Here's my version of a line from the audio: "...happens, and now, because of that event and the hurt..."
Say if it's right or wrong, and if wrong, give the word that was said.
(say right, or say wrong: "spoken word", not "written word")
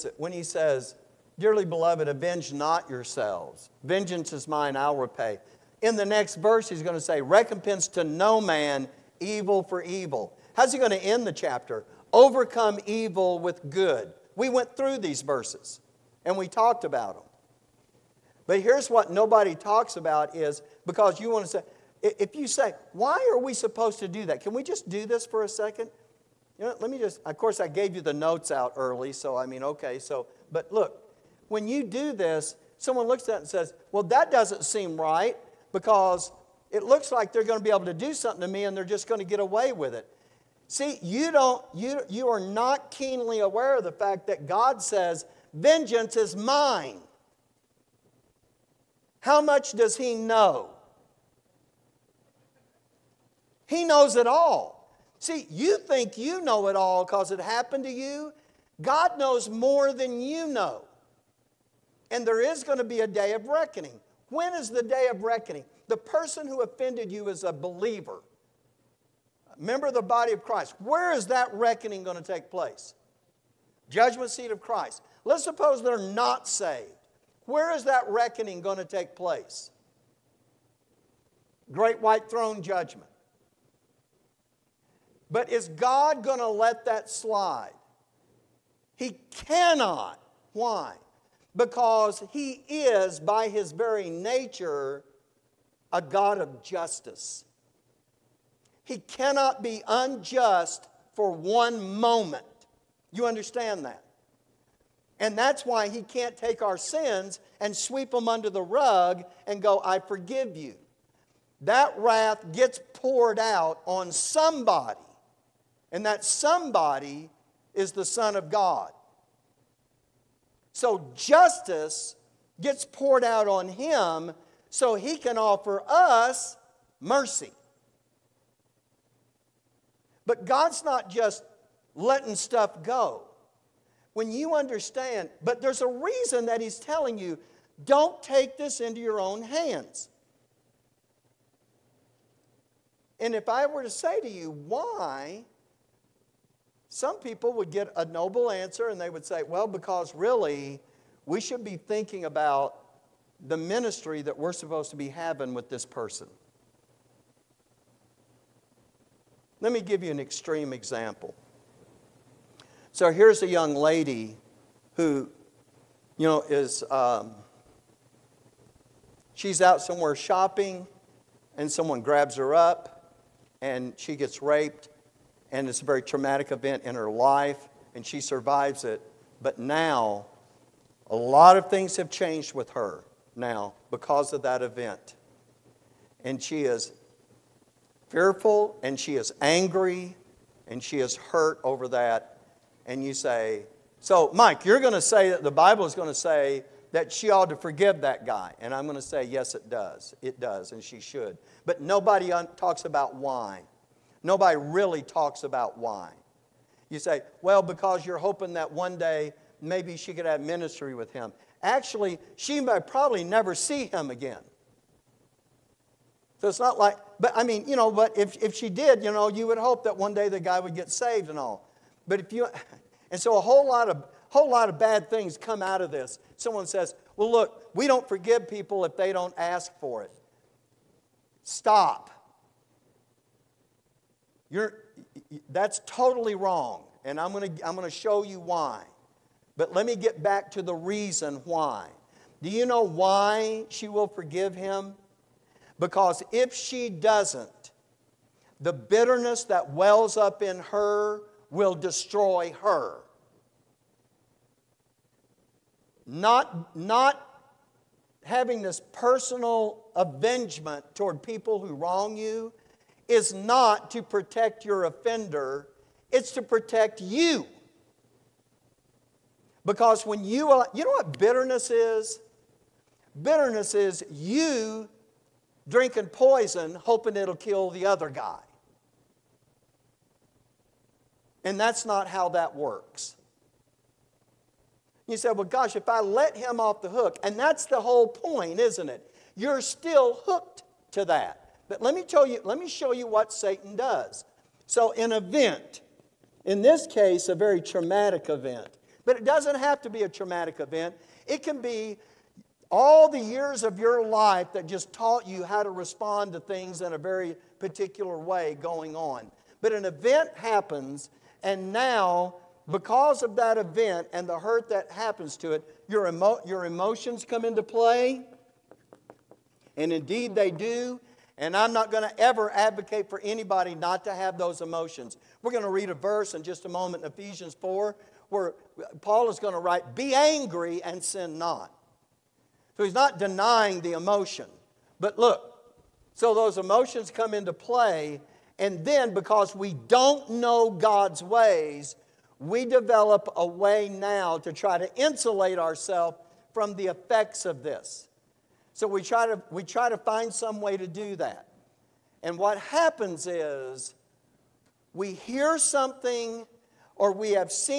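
right.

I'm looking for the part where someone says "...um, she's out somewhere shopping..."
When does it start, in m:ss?
2:46.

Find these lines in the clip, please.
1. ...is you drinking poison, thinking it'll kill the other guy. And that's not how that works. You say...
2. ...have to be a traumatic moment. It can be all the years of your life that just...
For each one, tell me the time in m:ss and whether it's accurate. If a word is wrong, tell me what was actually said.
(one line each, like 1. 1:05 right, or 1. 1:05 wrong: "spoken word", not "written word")
1. 4:33 wrong: "hoping", not "thinking"
2. 4:59 wrong: "event", not "moment".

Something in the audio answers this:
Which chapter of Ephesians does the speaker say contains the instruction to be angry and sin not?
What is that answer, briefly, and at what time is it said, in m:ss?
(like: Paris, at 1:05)
Ephesians 4, at 5:27.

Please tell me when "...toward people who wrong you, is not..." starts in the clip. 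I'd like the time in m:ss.
4:20.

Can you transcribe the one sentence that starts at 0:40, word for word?
See, you don't, you, you are not keenly aware of the fact that God says, vengeance is mine.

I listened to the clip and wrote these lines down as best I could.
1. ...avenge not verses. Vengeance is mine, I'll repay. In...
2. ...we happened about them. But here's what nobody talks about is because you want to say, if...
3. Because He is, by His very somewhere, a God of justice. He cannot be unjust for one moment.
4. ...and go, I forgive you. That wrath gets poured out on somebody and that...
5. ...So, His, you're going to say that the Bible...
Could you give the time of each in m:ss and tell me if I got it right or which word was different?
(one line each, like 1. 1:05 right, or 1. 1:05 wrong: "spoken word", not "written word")
1. 0:02 wrong: "yourselves", not "verses"
2. 0:16 wrong: "talked", not "happened"
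3. 1:31 wrong: "nature", not "somewhere"
4. 1:49 right
5. 3:13 wrong: "Mike", not "His".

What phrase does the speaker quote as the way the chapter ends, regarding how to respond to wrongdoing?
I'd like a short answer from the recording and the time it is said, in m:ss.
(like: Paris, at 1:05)
Overcome evil with good, at 0:12.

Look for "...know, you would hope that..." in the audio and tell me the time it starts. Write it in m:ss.
3:39.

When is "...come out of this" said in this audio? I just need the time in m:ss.
3:45.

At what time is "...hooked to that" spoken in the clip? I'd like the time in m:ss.
4:50.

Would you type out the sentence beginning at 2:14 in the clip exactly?
When you understand, but there's a reason that he's telling you don't take this into your own hands.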